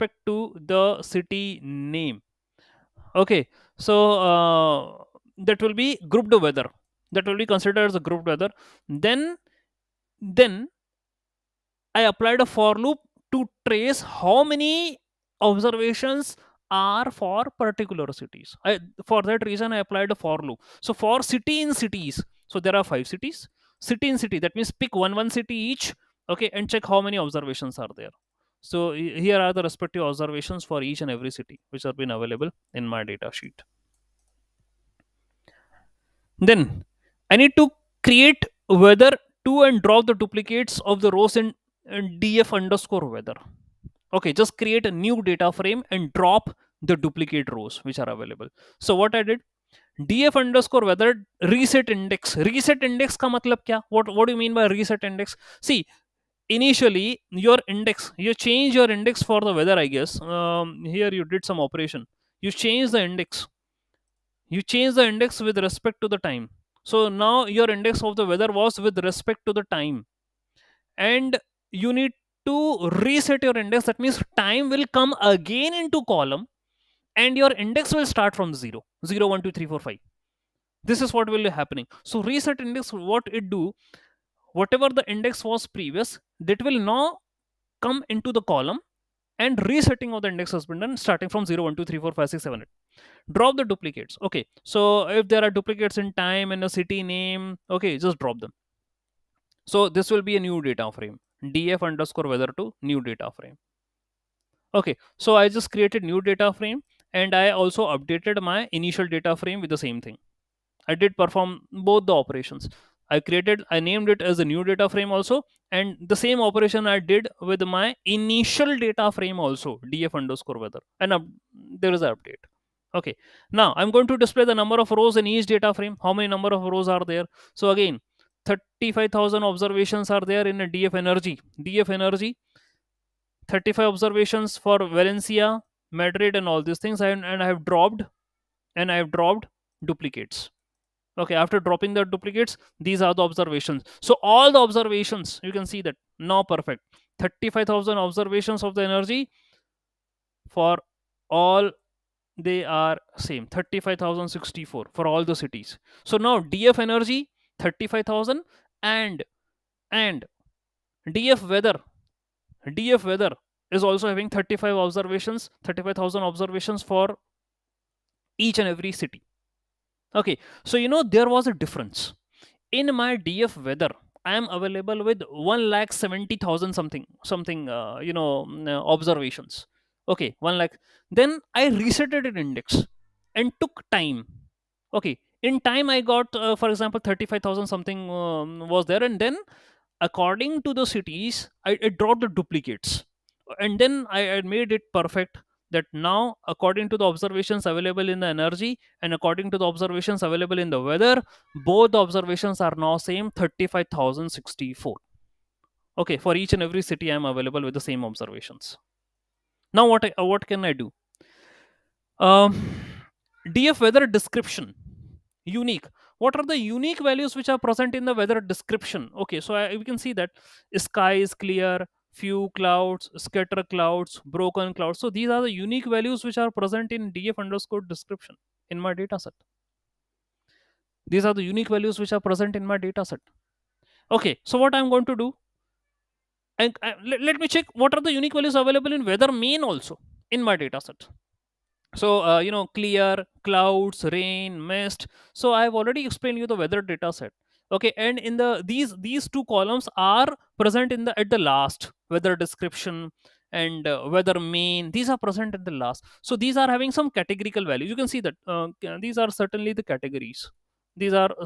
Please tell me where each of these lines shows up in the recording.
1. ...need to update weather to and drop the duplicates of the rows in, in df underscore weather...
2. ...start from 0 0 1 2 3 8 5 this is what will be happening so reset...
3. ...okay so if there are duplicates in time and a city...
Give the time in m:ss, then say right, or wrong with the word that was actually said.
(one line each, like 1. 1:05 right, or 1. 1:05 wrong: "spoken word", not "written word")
1. 0:37 wrong: "create", not "update"
2. 1:18 wrong: "4", not "8"
3. 1:34 right.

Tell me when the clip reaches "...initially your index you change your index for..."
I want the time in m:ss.
0:56.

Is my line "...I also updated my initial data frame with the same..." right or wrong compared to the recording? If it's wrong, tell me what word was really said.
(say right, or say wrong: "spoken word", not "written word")
right.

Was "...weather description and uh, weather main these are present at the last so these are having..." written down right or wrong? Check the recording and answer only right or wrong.
right.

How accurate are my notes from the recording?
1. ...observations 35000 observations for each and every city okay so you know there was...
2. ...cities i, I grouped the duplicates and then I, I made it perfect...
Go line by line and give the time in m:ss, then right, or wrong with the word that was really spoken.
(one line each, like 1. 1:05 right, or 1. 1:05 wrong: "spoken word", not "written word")
1. 2:44 right
2. 3:10 wrong: "dropped", not "grouped".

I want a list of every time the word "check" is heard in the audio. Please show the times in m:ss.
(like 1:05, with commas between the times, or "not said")
0:26, 3:57.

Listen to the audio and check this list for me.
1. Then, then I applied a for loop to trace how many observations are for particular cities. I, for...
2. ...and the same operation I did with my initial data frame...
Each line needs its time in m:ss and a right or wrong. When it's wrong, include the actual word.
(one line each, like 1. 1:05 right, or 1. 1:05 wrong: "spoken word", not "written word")
1. 0:08 right
2. 1:55 right.